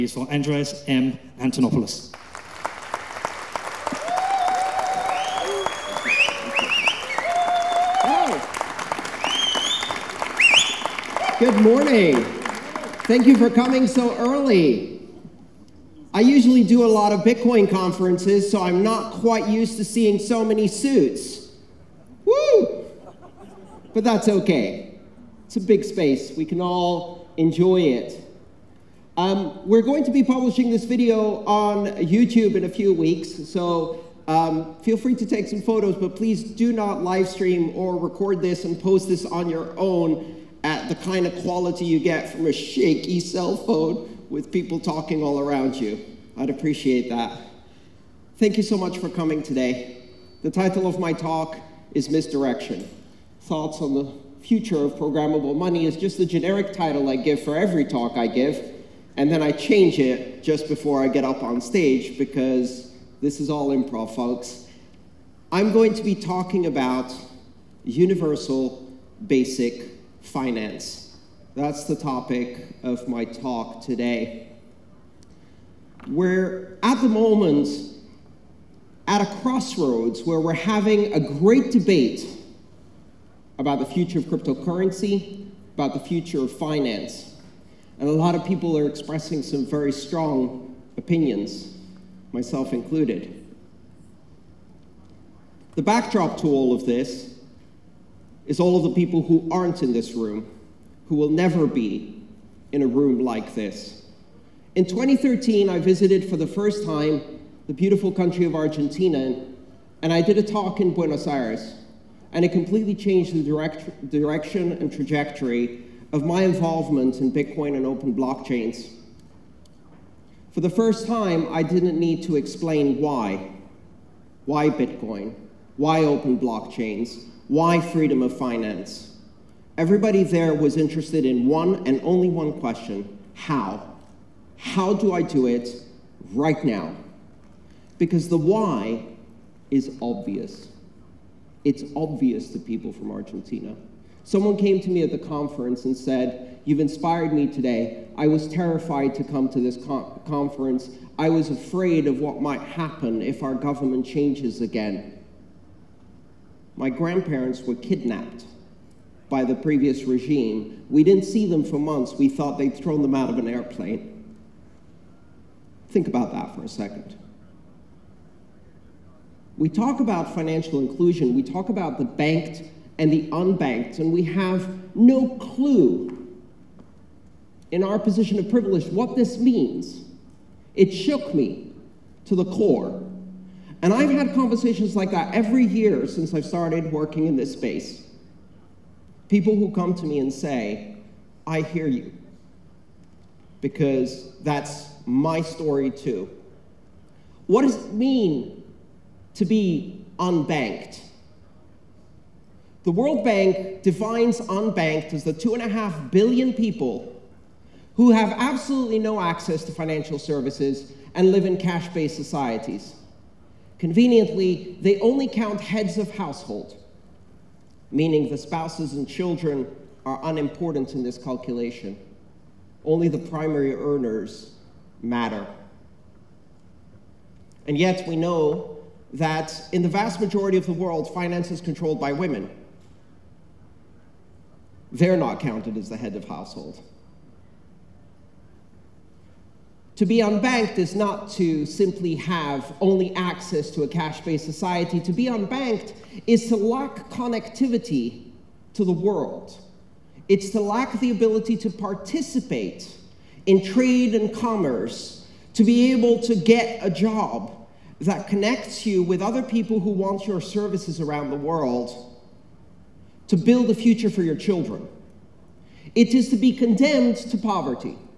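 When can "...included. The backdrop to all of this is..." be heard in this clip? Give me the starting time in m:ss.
1:32.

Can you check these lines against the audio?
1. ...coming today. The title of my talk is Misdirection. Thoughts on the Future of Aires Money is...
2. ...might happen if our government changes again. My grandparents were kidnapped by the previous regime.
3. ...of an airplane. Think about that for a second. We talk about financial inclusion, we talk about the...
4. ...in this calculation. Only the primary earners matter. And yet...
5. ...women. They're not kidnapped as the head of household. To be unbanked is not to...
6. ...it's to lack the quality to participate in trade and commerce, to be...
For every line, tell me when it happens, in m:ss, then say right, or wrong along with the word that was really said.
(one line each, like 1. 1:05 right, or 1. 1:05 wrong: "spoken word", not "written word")
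1. 0:49 wrong: "Programmable", not "Aires"
2. 2:32 right
3. 2:43 right
4. 3:40 right
5. 3:52 wrong: "counted", not "kidnapped"
6. 4:10 wrong: "ability", not "quality".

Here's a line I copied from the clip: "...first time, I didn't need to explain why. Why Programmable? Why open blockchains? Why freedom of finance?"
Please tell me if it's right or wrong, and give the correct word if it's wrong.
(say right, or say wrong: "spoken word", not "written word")
wrong: "Bitcoin", not "Programmable".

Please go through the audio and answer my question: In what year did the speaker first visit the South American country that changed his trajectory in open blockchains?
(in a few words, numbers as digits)
2013.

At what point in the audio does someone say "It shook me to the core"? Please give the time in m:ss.
3:00.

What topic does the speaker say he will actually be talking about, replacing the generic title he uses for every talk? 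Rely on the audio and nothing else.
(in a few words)
Universal basic finance.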